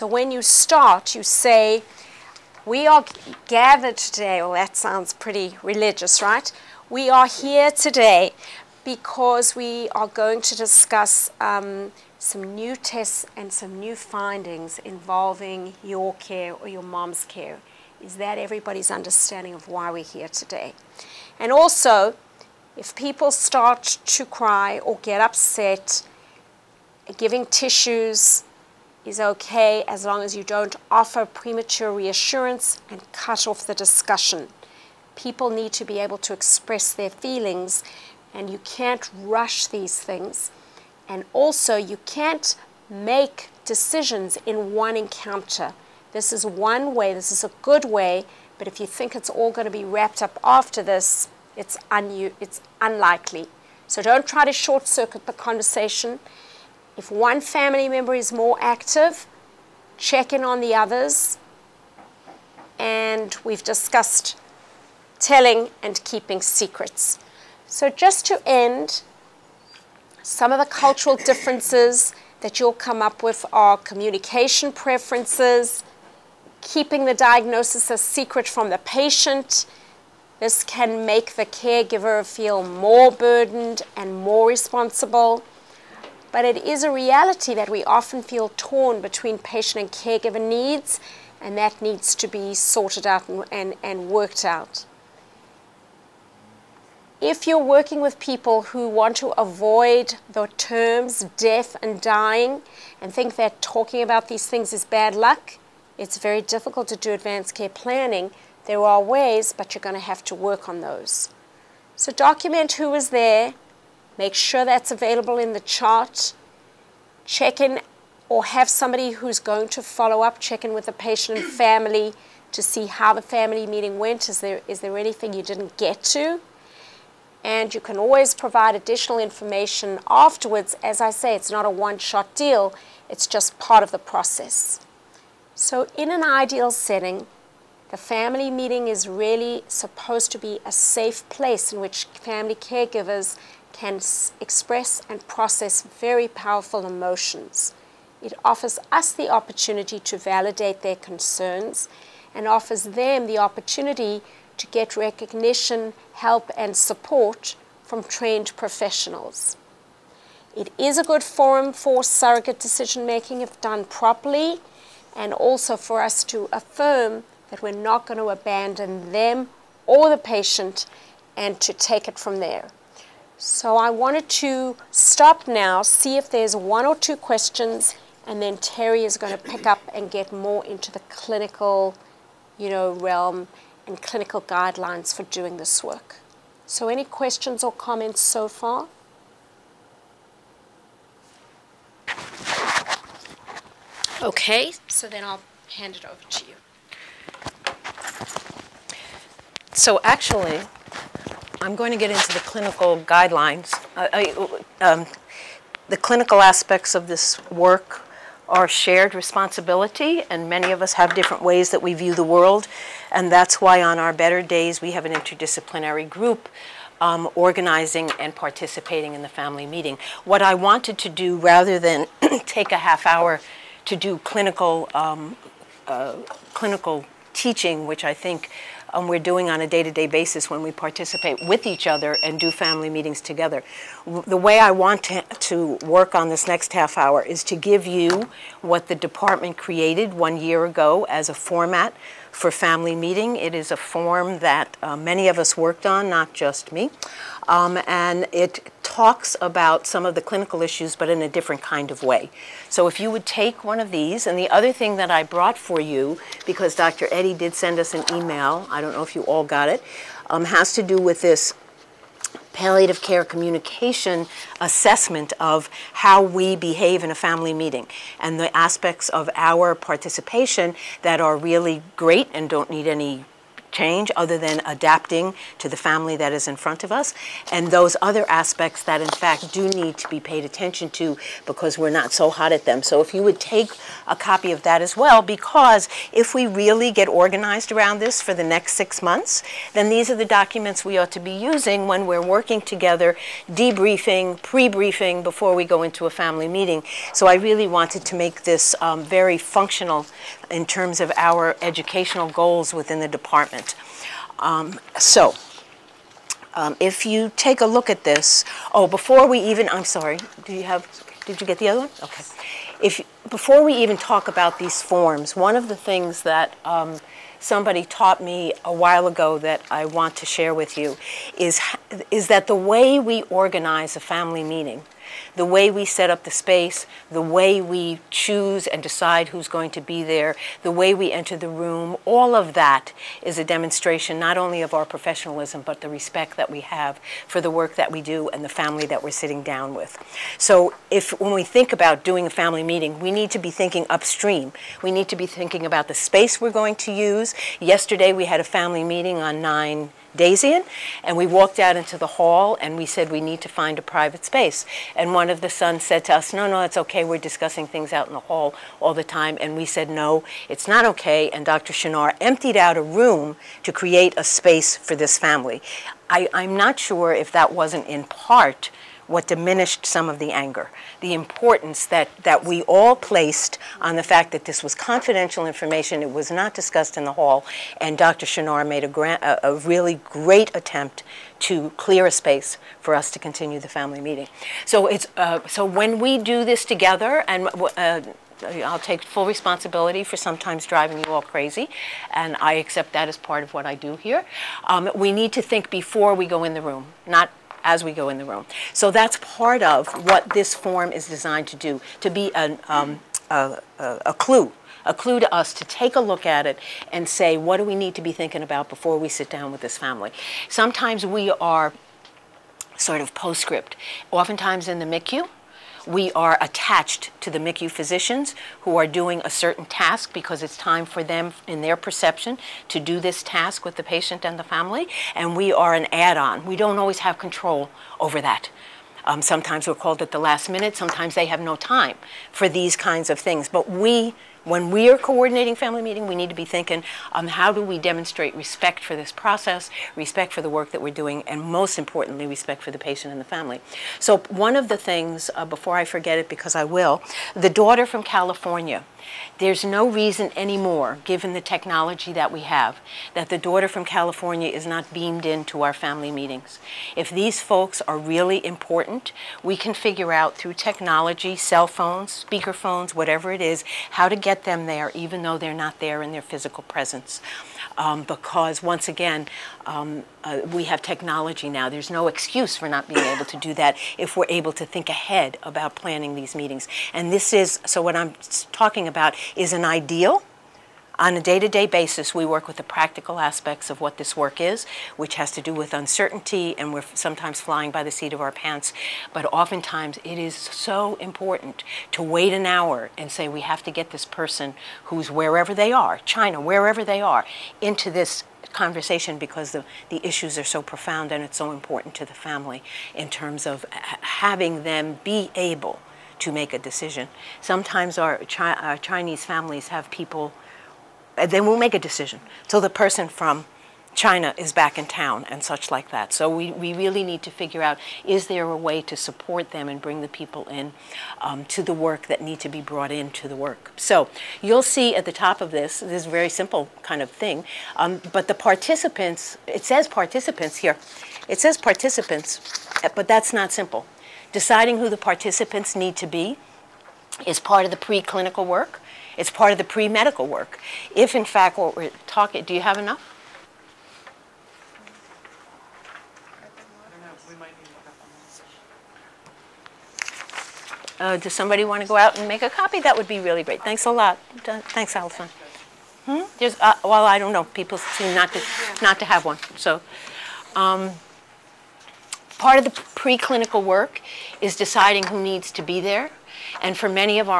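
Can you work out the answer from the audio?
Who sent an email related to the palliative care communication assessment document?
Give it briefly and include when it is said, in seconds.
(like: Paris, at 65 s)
Dr. Eddy, at 256 s.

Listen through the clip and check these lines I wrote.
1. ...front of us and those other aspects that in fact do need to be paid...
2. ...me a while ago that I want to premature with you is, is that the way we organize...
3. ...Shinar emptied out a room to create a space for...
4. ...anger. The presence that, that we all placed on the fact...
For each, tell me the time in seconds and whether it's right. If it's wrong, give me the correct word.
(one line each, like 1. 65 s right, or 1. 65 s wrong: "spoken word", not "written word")
1. 276 s right
2. 318 s wrong: "share", not "premature"
3. 361 s right
4. 370 s wrong: "importance", not "presence".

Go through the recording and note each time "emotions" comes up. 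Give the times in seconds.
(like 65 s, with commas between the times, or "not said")
146 s.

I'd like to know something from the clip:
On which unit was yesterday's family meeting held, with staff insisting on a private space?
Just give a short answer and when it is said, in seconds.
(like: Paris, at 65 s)
9 Dazian, at 349 s.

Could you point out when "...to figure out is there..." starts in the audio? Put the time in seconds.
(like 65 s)
517 s.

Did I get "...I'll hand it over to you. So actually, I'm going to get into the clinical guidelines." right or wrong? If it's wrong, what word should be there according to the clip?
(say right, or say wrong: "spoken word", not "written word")
right.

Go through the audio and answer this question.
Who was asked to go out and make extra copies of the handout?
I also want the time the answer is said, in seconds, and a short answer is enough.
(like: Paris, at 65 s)
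Alison, at 554 s.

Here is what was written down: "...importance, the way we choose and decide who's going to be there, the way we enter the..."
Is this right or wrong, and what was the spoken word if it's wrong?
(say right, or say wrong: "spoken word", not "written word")
wrong: "space", not "importance".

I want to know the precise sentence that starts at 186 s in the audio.
So any questions or comments so far?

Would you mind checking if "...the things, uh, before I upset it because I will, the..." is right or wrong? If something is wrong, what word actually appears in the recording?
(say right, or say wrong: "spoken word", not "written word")
wrong: "forget", not "upset".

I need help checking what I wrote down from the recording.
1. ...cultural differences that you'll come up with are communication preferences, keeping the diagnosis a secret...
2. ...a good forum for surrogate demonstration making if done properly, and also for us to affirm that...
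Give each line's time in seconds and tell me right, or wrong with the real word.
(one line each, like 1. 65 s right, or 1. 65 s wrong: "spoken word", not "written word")
1. 70 s right
2. 160 s wrong: "decision", not "demonstration".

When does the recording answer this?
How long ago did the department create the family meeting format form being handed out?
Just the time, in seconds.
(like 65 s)
240 s.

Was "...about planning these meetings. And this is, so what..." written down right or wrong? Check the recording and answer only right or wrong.
right.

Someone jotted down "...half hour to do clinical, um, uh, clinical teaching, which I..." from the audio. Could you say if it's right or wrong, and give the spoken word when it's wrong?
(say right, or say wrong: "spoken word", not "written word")
right.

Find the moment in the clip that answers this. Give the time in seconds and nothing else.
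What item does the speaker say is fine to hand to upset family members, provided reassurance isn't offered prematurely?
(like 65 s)
27 s.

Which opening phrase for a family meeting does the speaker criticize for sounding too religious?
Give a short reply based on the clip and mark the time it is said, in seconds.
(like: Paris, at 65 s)
We are gathered today, at 2 s.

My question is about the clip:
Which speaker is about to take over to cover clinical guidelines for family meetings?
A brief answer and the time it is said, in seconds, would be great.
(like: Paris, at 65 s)
Terry, at 178 s.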